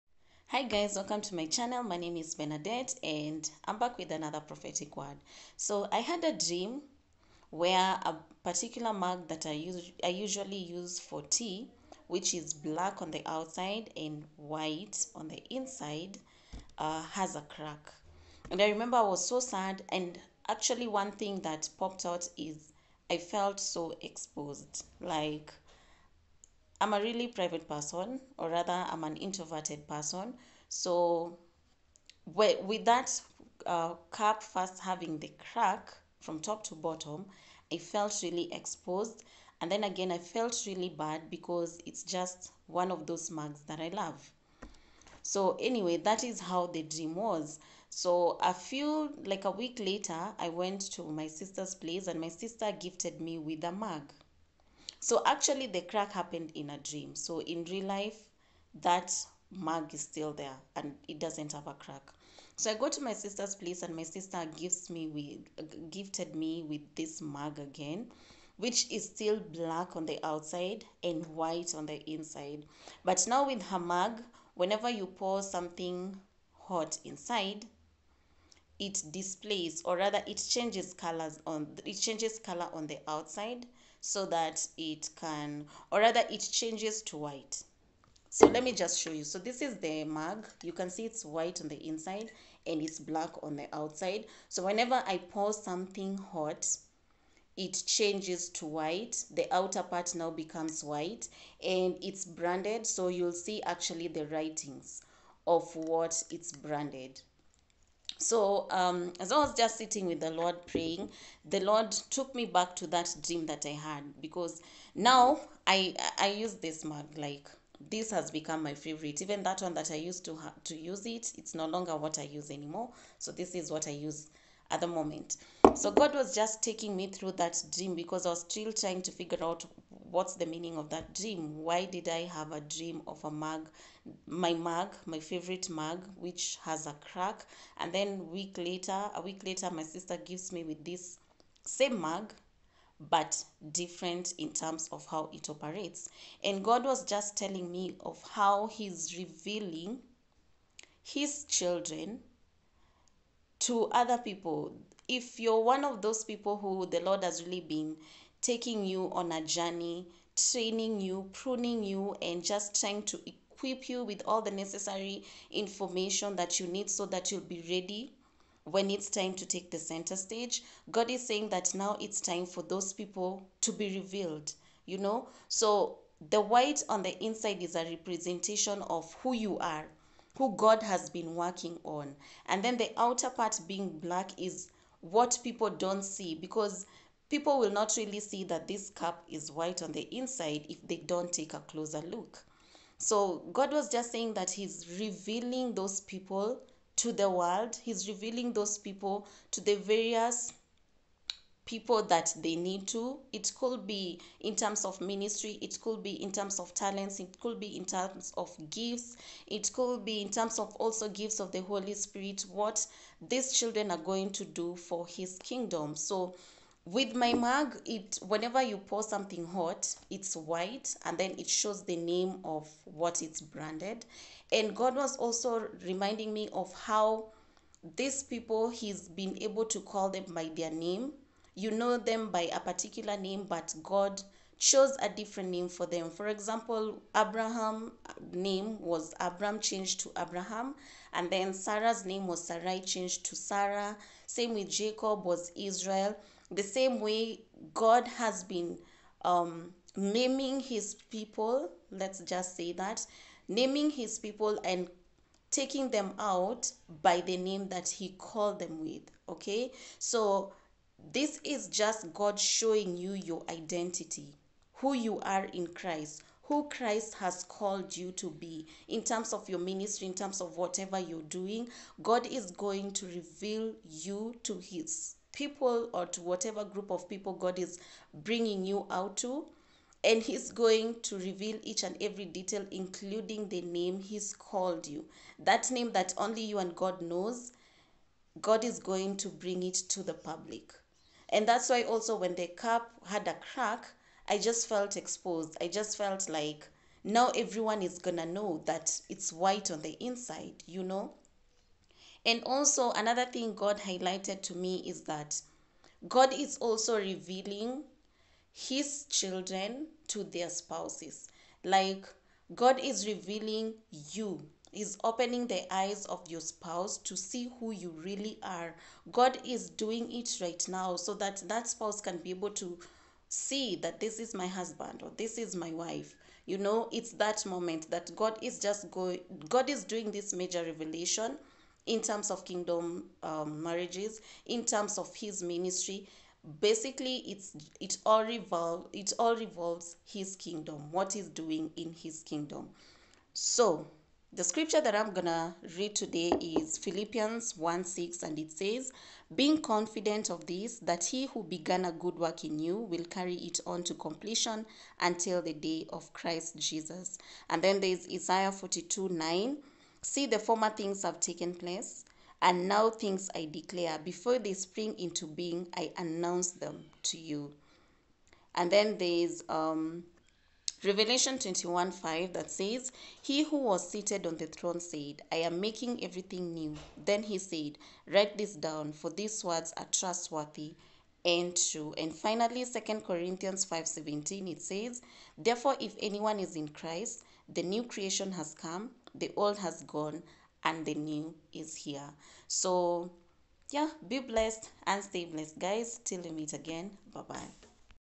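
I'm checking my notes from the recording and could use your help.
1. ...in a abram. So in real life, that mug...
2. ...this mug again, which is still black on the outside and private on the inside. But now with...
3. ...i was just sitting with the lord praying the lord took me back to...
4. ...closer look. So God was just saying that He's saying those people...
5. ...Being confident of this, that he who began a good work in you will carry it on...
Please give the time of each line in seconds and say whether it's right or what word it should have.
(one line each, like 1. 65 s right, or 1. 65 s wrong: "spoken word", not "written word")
1. 56 s wrong: "dream", not "abram"
2. 66 s wrong: "white", not "private"
3. 109 s right
4. 191 s wrong: "revealing", not "saying"
5. 349 s right.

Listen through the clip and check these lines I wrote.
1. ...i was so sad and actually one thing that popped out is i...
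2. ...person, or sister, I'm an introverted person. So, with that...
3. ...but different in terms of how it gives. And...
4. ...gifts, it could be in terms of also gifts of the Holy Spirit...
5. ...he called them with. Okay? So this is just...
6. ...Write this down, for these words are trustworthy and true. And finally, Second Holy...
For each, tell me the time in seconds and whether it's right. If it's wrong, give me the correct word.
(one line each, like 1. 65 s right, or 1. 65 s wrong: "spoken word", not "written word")
1. 18 s right
2. 27 s wrong: "rather", not "sister"
3. 143 s wrong: "operates", not "gives"
4. 208 s right
5. 257 s right
6. 378 s wrong: "Corinthians", not "Holy".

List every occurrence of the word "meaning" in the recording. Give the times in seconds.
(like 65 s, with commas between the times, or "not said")
130 s.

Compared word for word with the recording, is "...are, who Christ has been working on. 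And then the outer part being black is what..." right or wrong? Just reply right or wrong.
wrong.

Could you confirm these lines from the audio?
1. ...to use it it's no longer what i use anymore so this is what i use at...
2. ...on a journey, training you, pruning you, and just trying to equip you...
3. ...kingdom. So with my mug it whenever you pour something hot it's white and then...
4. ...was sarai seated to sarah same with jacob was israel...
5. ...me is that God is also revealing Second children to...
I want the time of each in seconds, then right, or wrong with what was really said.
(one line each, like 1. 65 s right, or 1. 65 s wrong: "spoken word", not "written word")
1. 120 s right
2. 159 s right
3. 215 s right
4. 242 s wrong: "changed", not "seated"
5. 304 s wrong: "His", not "Second".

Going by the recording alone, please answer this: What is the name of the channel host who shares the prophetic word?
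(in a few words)
Benedette.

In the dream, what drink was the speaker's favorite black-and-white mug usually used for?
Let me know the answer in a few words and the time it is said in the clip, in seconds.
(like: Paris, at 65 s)
Tea, at 11 s.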